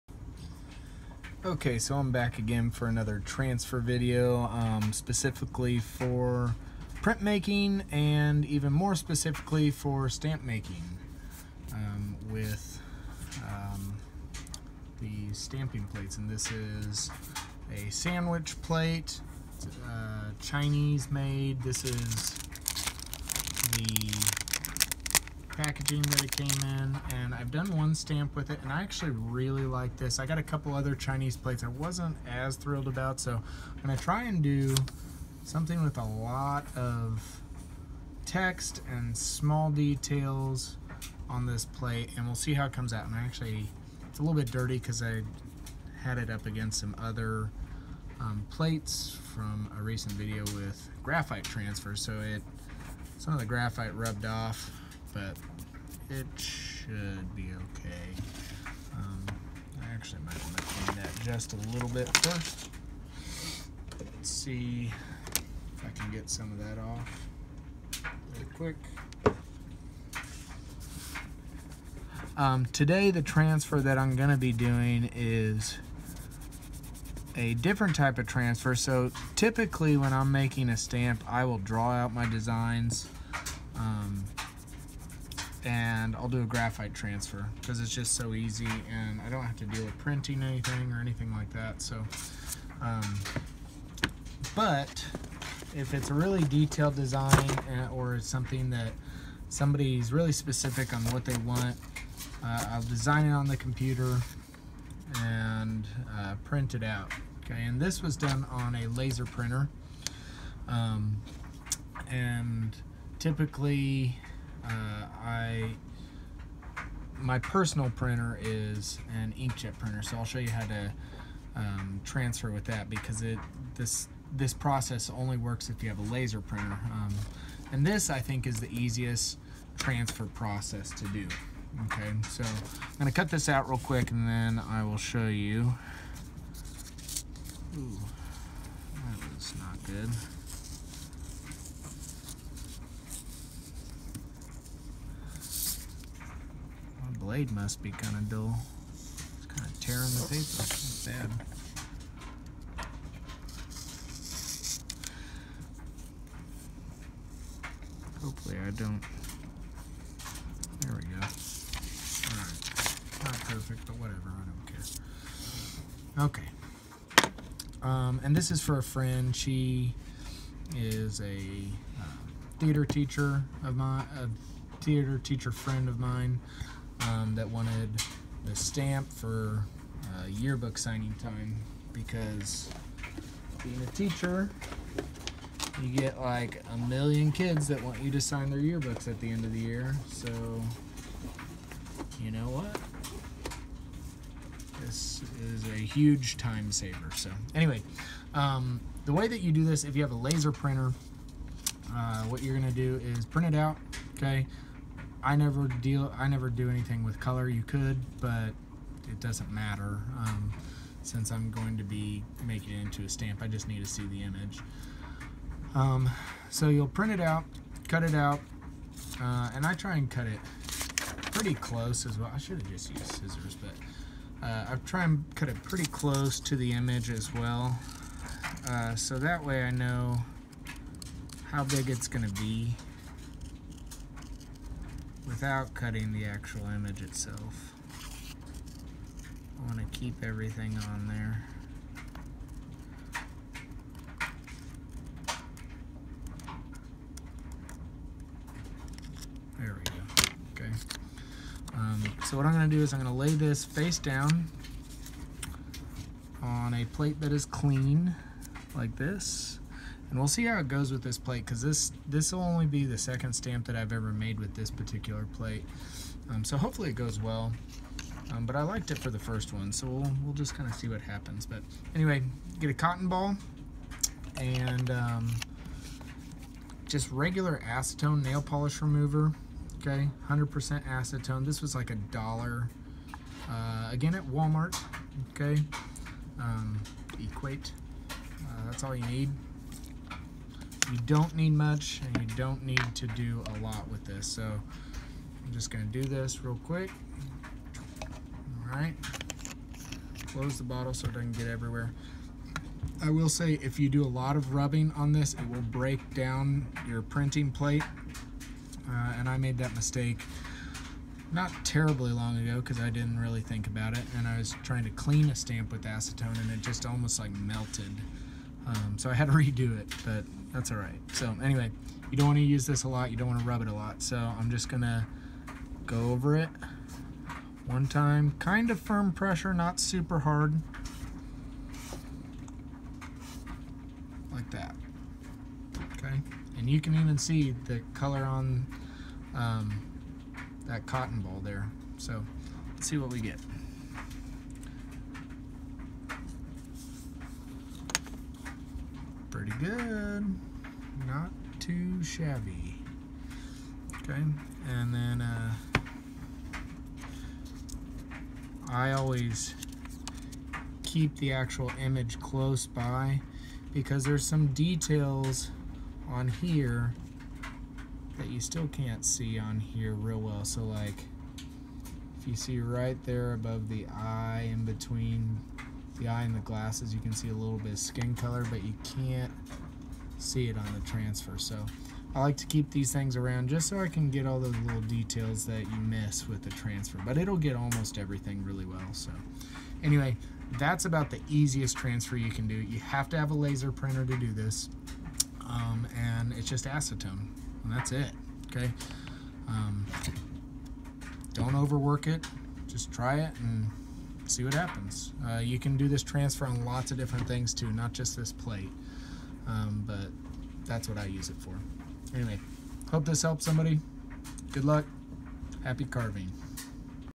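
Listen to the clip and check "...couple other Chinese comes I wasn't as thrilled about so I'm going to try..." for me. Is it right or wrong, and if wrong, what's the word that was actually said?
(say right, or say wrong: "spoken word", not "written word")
wrong: "plates", not "comes".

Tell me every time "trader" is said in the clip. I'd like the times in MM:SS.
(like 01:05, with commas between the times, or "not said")
not said.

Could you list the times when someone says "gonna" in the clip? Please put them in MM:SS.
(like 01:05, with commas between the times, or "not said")
02:12, 04:55.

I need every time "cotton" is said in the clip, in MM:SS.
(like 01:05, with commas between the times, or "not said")
04:32, 05:40.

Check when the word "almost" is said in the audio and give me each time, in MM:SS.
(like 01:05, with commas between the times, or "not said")
05:16, 06:27.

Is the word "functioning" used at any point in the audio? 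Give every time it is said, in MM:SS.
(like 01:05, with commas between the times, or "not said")
not said.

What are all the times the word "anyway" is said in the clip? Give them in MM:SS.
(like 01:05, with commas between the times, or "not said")
03:17, 04:31, 05:21, 06:29, 06:52.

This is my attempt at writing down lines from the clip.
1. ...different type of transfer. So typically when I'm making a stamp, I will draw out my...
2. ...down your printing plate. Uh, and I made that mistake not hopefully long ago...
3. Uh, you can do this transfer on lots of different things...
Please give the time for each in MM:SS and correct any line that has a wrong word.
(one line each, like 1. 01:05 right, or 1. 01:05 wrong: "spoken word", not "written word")
1. 01:17 right
2. 05:06 wrong: "terribly", not "hopefully"
3. 06:45 right.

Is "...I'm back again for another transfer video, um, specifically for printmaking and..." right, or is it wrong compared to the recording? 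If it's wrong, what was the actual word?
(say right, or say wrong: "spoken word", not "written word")
right.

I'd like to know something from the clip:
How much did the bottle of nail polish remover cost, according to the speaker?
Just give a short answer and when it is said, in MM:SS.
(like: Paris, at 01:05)
a dollar, at 04:41.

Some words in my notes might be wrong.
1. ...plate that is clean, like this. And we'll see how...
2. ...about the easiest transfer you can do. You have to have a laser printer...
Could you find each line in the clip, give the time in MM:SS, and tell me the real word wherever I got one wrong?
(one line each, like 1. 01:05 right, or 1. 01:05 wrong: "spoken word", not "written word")
1. 04:16 right
2. 06:30 right.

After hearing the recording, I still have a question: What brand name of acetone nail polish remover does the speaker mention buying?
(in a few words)
Equate.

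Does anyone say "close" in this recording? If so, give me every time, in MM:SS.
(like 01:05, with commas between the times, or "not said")
03:41, 03:45, 05:00, 06:02.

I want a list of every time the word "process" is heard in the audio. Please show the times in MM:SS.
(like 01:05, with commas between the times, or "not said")
02:04, 02:10.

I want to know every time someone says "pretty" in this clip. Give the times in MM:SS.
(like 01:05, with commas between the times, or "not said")
03:41, 03:45, 05:49.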